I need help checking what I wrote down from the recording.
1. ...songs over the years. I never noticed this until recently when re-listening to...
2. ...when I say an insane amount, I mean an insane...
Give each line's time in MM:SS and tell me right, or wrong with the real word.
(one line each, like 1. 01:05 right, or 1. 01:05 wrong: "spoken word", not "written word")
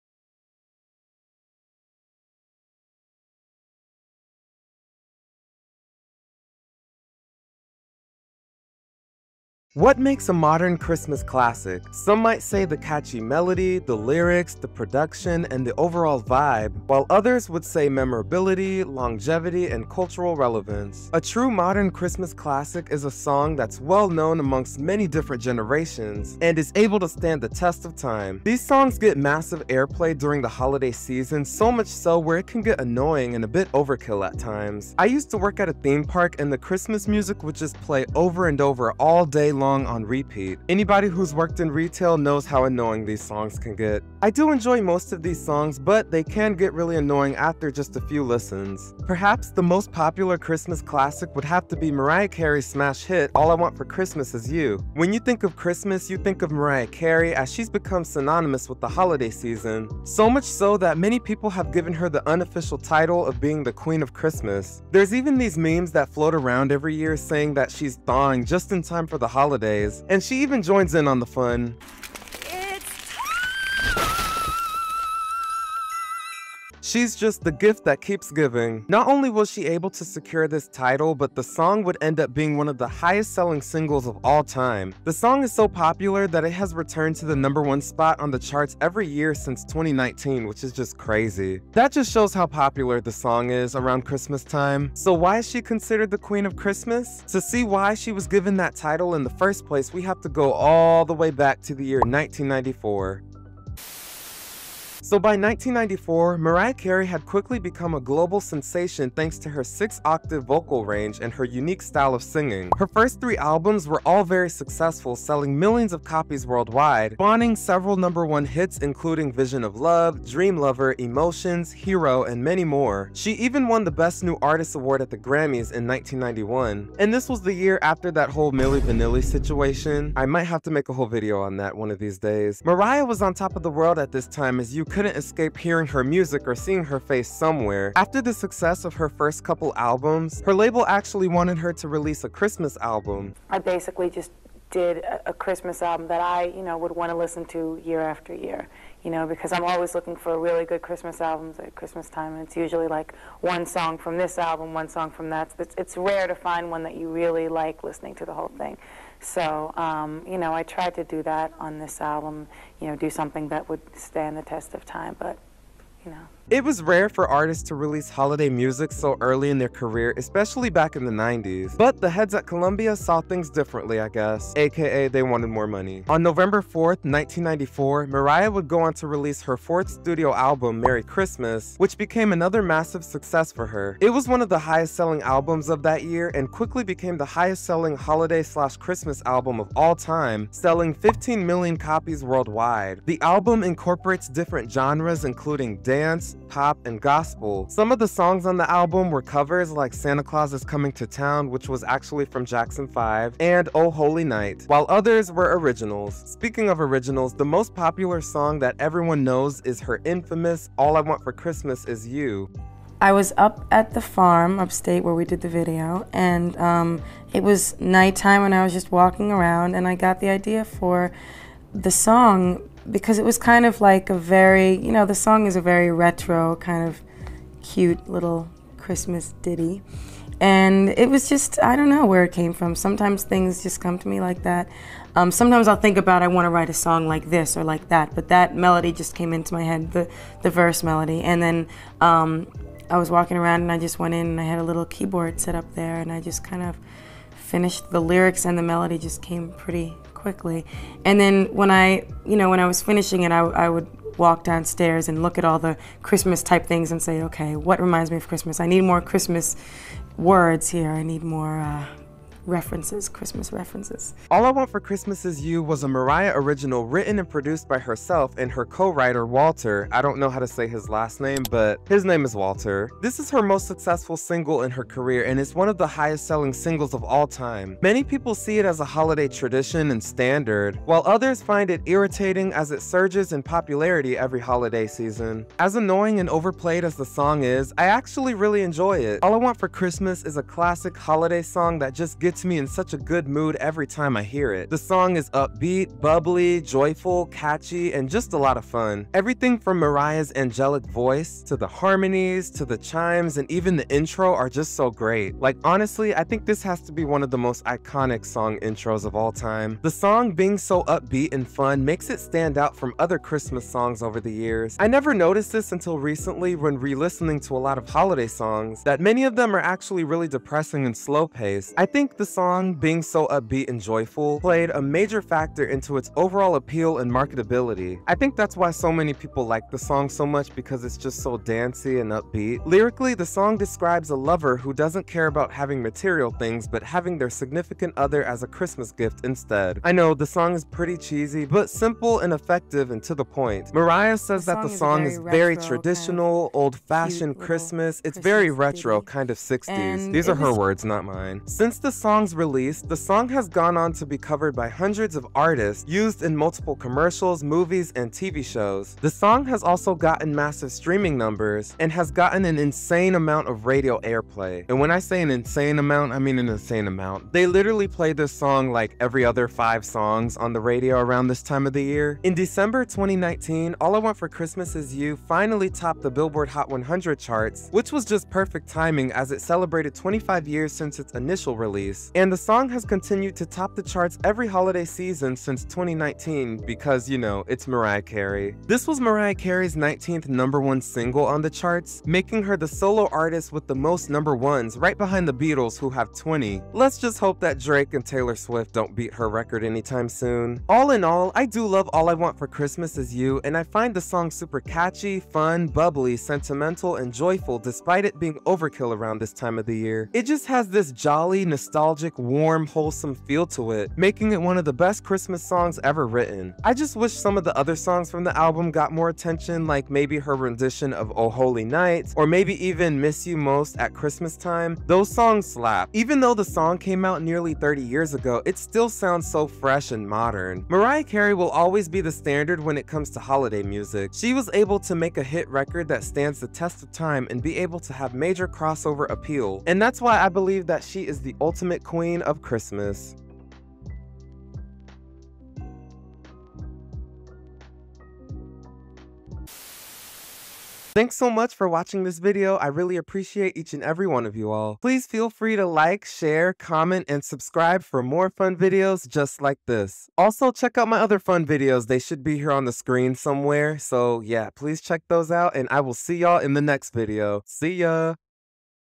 1. 05:13 right
2. 06:04 right.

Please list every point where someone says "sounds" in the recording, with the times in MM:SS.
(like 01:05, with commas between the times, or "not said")
07:08.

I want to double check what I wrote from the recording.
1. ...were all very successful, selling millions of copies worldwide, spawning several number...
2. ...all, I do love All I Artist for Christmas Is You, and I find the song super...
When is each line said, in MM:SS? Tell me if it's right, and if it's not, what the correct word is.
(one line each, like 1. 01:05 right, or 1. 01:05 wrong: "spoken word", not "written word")
1. 01:53 right
2. 06:41 wrong: "Want", not "Artist".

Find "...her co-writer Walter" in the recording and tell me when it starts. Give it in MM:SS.
04:28.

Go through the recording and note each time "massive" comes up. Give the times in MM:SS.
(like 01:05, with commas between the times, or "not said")
00:29, 03:02, 06:00.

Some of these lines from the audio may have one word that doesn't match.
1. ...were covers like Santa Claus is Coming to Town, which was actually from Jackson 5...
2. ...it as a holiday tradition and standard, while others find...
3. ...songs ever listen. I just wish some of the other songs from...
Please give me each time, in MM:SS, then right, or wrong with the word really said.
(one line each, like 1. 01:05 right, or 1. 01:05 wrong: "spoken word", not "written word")
1. 03:19 right
2. 04:38 right
3. 06:55 wrong: "written", not "listen".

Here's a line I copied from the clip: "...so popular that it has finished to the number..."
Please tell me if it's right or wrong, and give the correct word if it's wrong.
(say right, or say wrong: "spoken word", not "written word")
wrong: "returned", not "finished".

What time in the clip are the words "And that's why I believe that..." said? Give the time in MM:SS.
07:19.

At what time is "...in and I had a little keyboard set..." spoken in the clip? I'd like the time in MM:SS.
04:04.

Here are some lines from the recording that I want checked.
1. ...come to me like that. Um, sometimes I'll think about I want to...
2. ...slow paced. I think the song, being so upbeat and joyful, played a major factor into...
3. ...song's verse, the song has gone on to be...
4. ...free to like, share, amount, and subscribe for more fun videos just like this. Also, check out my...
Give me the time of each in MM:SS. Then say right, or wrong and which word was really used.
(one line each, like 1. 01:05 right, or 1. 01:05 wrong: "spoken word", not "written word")
1. 03:53 right
2. 05:20 right
3. 05:52 wrong: "release", not "verse"
4. 07:35 wrong: "comment", not "amount".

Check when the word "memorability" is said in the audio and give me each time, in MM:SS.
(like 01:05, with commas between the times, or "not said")
00:17.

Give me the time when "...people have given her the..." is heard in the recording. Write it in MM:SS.
01:01.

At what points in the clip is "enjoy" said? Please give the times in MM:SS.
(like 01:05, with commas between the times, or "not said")
00:44, 04:48.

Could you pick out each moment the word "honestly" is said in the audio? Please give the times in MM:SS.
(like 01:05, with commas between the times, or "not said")
05:05.